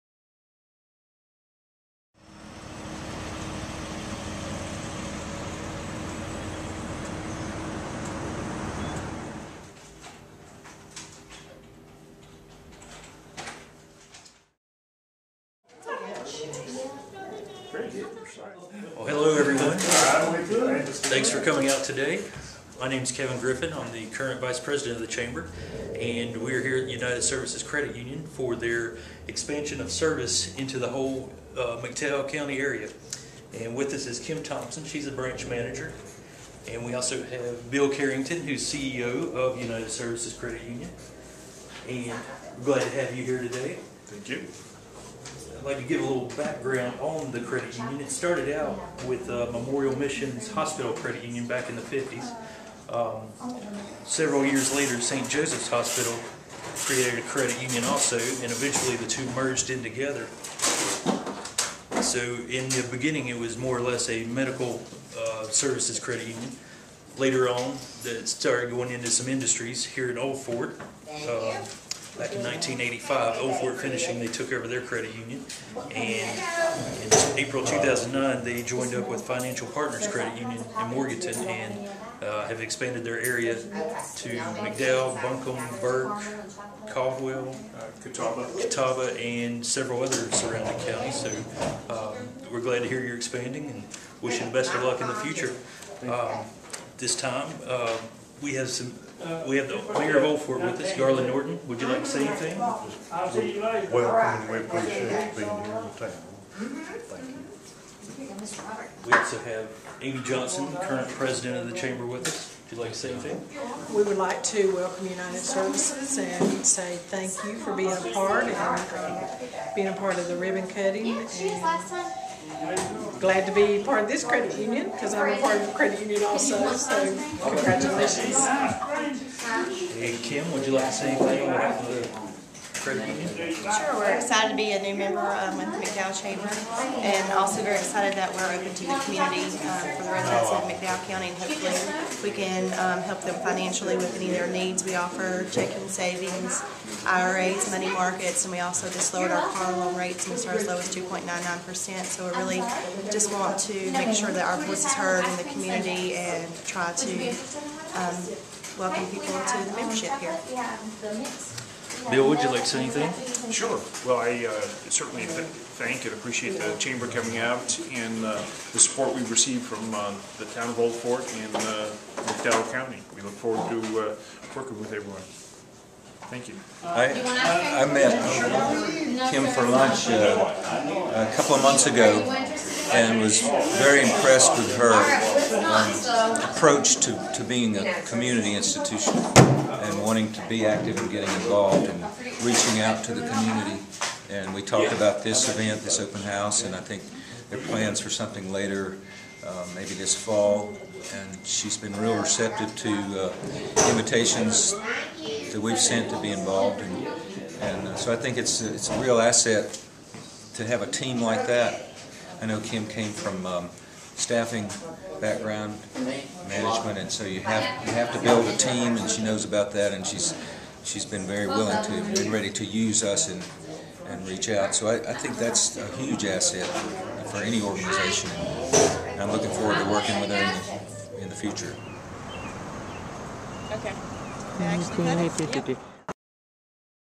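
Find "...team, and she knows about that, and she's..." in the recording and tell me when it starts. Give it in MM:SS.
03:38.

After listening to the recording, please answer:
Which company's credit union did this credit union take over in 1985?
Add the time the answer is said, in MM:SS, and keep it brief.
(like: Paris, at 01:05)
Old Fort Finishing, at 01:13.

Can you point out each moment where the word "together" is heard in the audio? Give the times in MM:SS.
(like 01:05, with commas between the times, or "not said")
00:59.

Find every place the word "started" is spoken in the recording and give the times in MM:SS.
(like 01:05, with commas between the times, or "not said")
00:48, 01:08, 02:30.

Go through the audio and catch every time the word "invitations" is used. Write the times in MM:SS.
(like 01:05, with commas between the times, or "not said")
03:23.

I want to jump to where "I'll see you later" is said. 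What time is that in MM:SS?
01:42.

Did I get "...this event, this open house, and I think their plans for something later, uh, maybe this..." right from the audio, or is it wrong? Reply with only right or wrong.
right.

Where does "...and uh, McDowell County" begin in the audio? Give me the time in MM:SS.
02:51.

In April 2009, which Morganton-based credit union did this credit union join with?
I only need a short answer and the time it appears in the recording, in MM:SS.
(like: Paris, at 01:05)
Financial Partners Credit Union, at 01:19.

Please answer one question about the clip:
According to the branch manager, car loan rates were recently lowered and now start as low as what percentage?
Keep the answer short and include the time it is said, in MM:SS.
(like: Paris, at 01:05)
2.99%, at 02:30.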